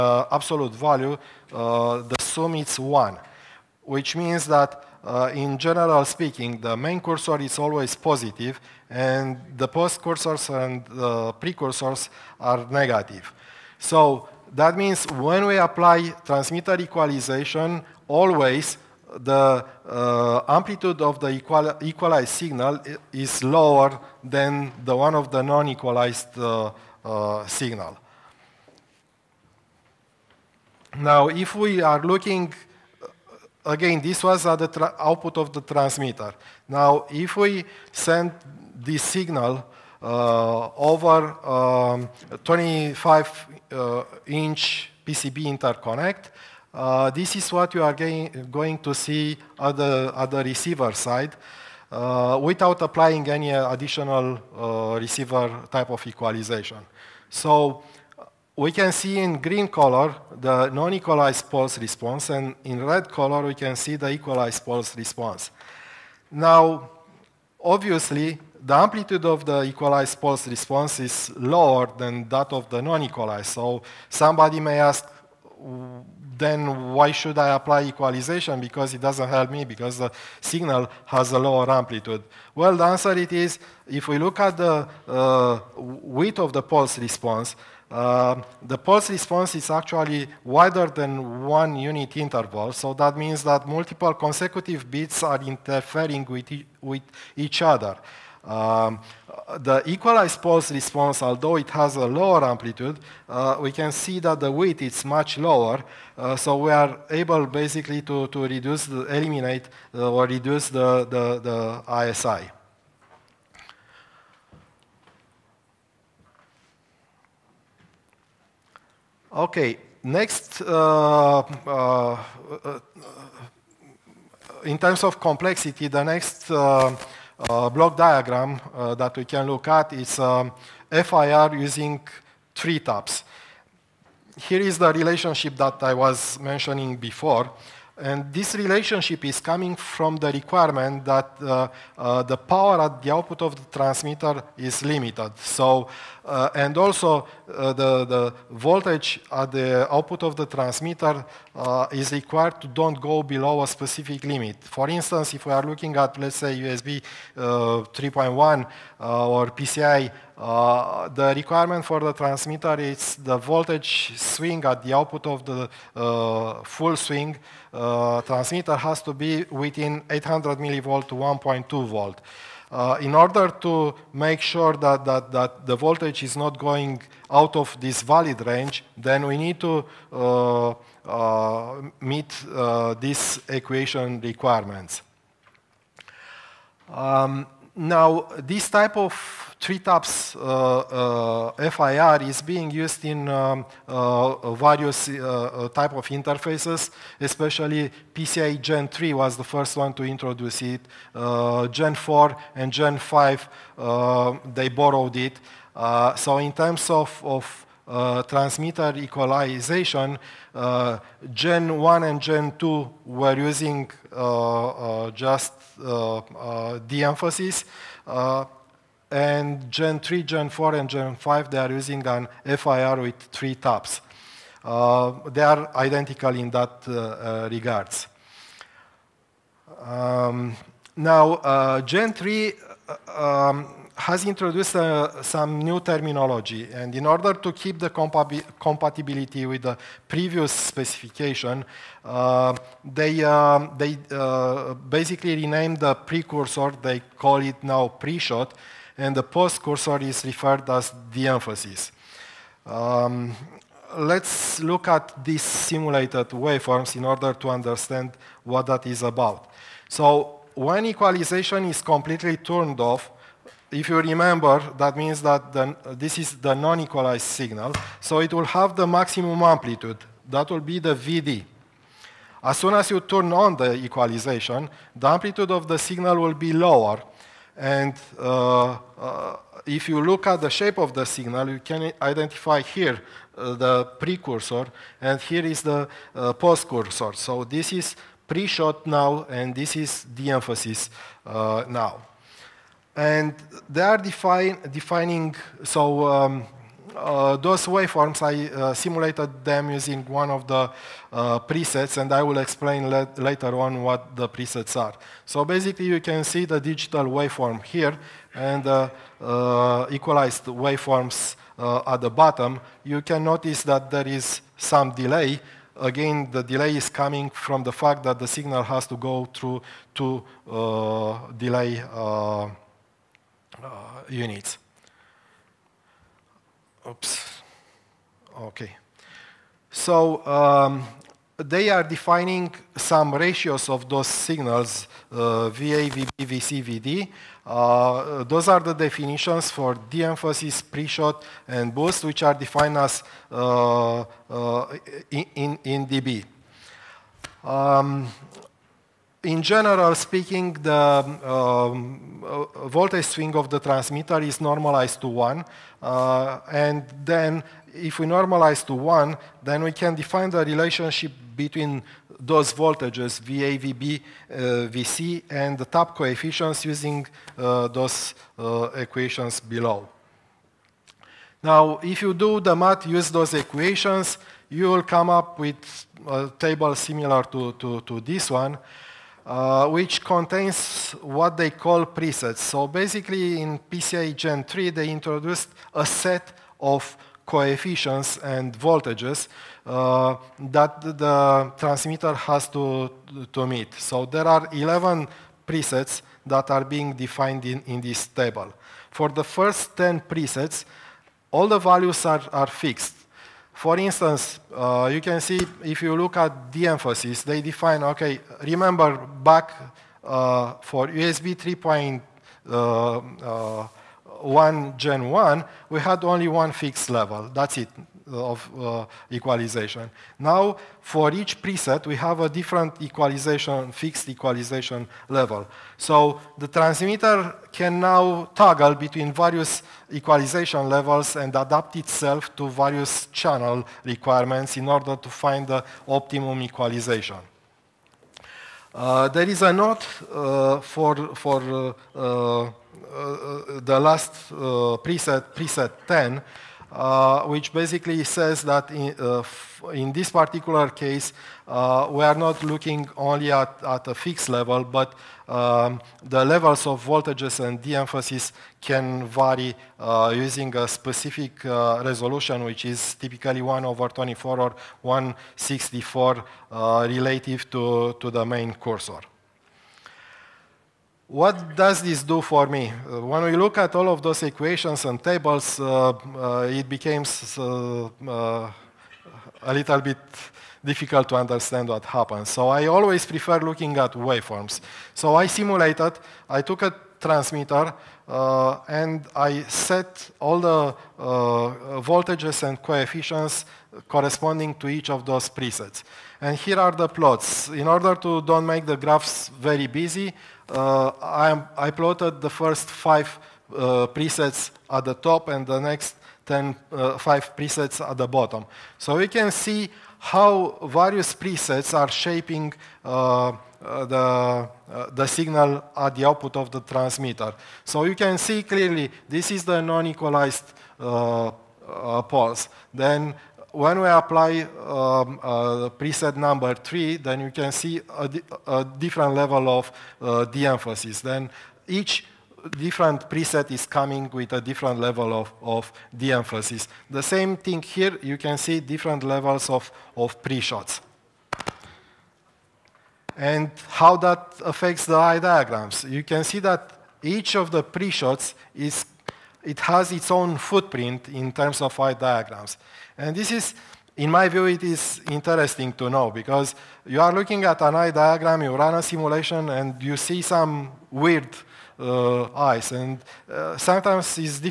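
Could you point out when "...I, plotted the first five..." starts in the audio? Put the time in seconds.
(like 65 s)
501 s.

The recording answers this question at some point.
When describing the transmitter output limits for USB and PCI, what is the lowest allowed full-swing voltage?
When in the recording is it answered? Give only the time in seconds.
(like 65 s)
170 s.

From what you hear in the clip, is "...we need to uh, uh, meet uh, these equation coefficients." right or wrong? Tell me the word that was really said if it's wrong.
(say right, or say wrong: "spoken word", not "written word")
wrong: "requirements", not "coefficients".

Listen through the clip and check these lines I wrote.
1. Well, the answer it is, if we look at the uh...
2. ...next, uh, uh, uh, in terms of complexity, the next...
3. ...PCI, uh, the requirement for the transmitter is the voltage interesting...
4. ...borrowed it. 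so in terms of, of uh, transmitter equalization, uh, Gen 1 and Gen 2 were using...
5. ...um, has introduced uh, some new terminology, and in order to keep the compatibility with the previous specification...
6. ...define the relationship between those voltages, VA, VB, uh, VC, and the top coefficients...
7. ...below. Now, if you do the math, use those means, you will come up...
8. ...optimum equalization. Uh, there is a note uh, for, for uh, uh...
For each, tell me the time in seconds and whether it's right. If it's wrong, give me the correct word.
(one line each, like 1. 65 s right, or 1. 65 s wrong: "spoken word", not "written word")
1. 82 s right
2. 120 s right
3. 159 s wrong: "swing", not "interesting"
4. 204 s right
5. 233 s right
6. 359 s right
7. 369 s wrong: "equations", not "means"
8. 435 s right.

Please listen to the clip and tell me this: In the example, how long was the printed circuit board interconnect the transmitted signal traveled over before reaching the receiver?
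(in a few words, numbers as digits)
25 inch.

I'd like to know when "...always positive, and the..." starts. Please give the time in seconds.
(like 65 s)
7 s.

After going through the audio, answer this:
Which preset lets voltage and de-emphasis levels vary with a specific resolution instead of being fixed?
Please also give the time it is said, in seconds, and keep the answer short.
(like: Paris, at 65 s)
preset 10, at 445 s.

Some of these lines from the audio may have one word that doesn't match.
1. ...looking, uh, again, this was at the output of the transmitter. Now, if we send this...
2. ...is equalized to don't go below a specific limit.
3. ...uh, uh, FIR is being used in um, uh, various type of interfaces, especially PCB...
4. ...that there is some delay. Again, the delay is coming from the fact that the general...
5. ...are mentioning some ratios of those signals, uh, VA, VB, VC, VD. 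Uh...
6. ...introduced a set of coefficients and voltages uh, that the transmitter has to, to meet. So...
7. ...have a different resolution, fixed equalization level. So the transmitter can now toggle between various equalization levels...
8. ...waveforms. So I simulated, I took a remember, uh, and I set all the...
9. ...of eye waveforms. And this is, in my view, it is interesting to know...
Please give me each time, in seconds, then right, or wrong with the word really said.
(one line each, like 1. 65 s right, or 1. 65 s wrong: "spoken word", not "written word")
1. 32 s right
2. 151 s wrong: "required", not "equalized"
3. 190 s wrong: "PCI", not "PCB"
4. 313 s wrong: "signal", not "general"
5. 331 s wrong: "defining", not "mentioning"
6. 384 s right
7. 421 s wrong: "equalization", not "resolution"
8. 483 s wrong: "transmitter", not "remember"
9. 551 s wrong: "diagrams", not "waveforms".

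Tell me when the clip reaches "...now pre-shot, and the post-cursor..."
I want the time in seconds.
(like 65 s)
247 s.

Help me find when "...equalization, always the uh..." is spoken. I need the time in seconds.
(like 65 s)
16 s.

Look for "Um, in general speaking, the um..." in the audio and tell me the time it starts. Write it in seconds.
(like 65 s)
347 s.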